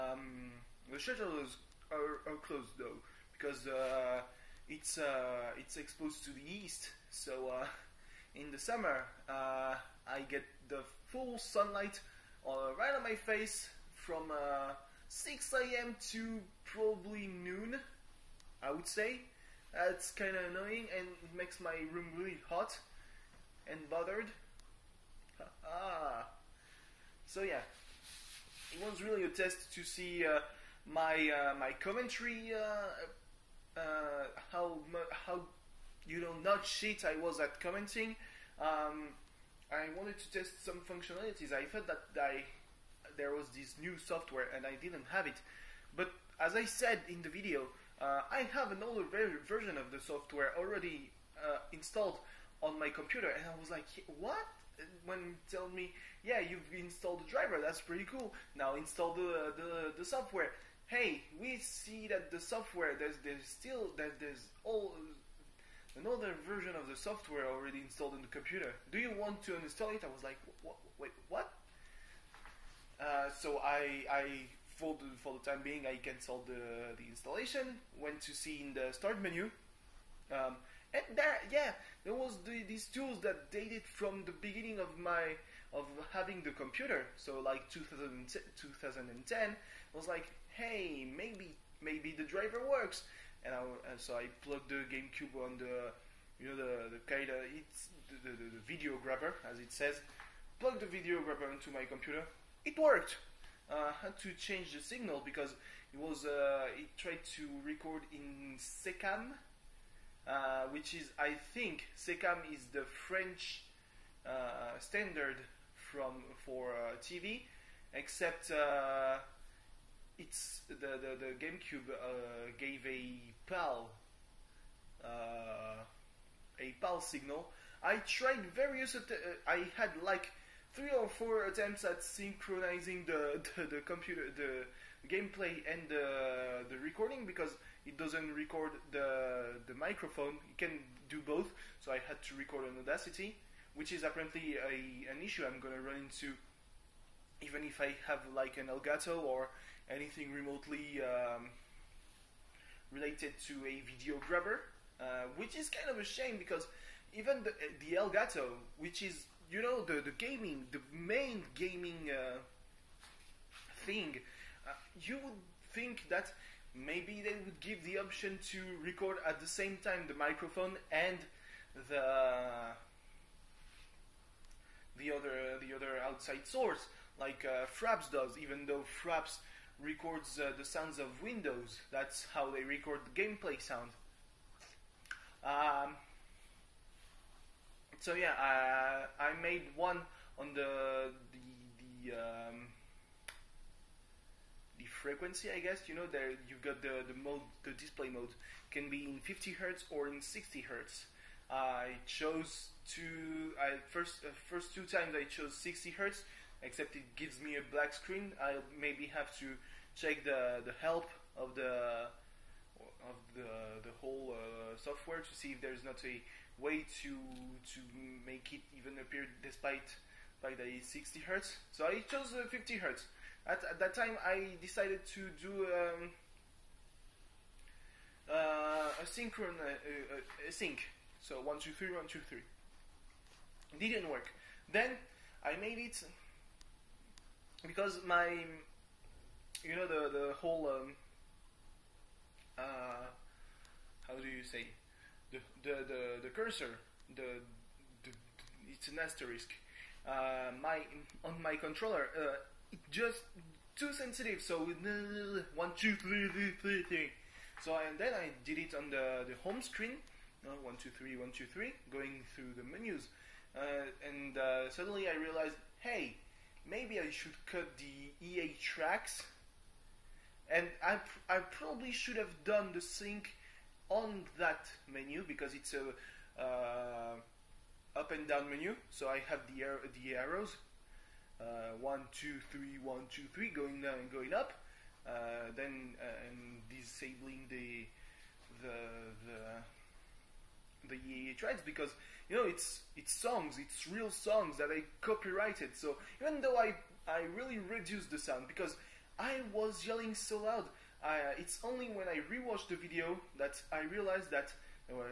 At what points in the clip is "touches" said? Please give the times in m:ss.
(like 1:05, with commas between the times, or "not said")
not said.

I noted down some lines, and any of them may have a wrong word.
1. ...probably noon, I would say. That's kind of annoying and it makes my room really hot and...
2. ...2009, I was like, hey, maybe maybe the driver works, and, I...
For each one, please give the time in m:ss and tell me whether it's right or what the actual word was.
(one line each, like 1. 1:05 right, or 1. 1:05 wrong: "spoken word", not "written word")
1. 0:16 right
2. 1:28 wrong: "2010", not "2009".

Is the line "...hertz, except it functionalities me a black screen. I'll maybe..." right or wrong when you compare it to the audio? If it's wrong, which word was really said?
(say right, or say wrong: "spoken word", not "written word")
wrong: "gives", not "functionalities".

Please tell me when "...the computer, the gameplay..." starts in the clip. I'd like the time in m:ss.
2:13.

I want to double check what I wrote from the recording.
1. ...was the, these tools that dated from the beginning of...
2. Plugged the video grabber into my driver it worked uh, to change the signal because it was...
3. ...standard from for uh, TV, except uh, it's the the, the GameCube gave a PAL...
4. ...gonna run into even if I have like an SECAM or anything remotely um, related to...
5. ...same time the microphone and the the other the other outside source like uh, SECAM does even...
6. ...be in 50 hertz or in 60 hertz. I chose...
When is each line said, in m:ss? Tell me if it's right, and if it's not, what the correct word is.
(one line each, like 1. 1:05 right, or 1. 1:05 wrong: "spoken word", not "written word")
1. 1:22 right
2. 1:40 wrong: "computer", not "driver"
3. 1:54 right
4. 2:25 wrong: "Elgato", not "SECAM"
5. 2:49 wrong: "Fraps", not "SECAM"
6. 3:18 right.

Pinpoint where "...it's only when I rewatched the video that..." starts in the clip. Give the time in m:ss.
5:01.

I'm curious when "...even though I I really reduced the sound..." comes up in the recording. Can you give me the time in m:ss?
4:56.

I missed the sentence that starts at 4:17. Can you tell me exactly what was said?
So and then I did it on the, the home screen, uh, one, two, three, one, two, three, going through the menus.